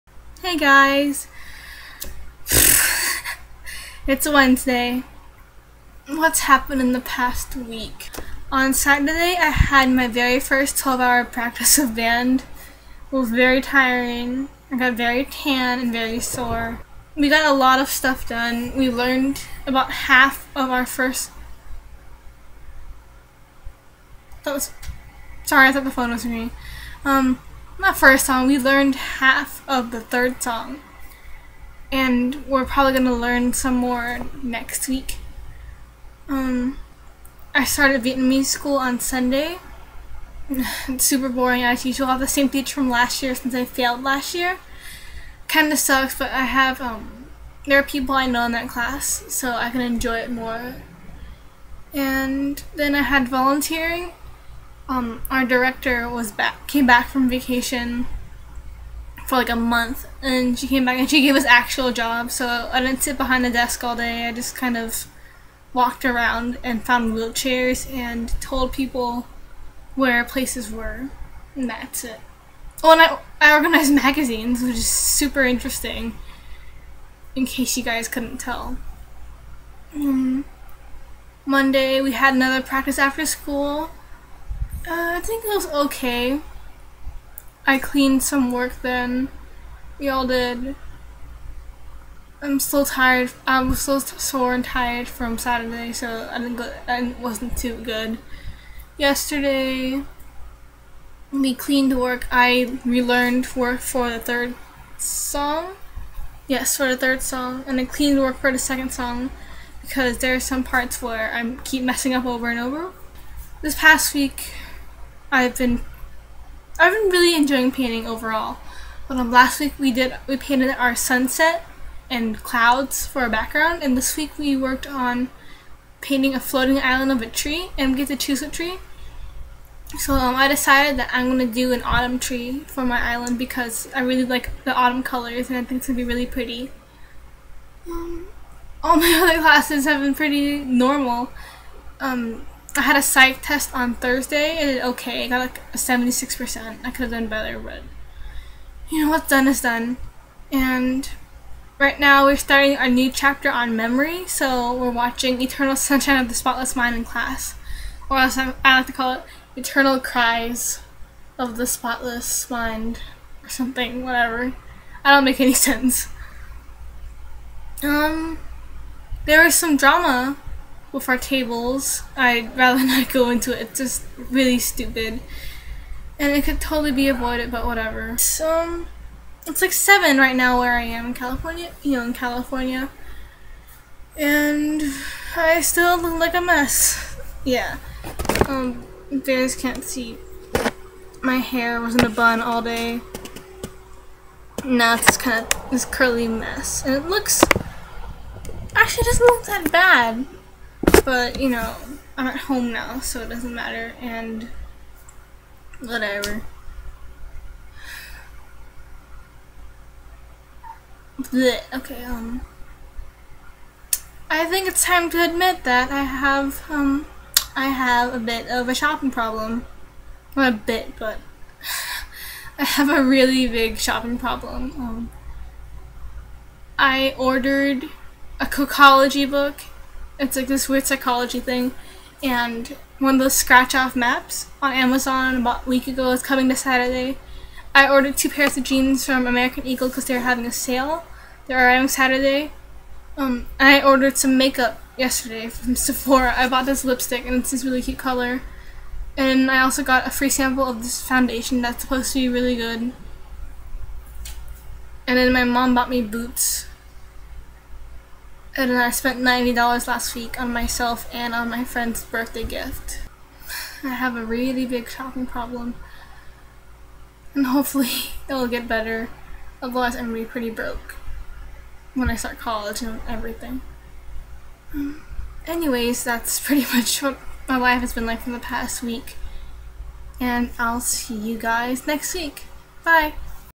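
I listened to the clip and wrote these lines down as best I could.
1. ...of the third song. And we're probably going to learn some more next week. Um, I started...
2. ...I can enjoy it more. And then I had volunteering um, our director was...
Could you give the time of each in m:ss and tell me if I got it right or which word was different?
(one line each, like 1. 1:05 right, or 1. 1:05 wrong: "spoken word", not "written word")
1. 0:29 right
2. 0:49 right.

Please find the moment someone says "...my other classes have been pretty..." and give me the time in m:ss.
2:18.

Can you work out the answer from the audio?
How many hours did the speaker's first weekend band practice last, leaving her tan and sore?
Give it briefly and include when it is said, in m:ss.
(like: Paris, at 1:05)
12, at 0:10.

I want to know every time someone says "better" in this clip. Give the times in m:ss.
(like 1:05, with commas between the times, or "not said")
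2:27, 4:28.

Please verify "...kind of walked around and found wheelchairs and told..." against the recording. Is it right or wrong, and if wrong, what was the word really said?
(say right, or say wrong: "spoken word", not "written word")
right.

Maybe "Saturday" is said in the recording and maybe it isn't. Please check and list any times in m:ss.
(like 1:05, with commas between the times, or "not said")
0:08, 1:35, 3:56, 4:01.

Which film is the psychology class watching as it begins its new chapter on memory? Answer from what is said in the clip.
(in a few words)
Eternal Sunshine of the Spotless Mind.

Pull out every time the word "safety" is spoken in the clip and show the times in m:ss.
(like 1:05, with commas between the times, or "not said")
not said.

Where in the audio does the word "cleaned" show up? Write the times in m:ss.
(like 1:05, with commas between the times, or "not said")
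1:27, 1:41, 1:47.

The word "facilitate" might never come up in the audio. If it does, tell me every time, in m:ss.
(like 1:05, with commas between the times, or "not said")
not said.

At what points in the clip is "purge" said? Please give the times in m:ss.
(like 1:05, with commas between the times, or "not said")
not said.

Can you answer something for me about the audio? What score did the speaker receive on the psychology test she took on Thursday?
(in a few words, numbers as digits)
76%.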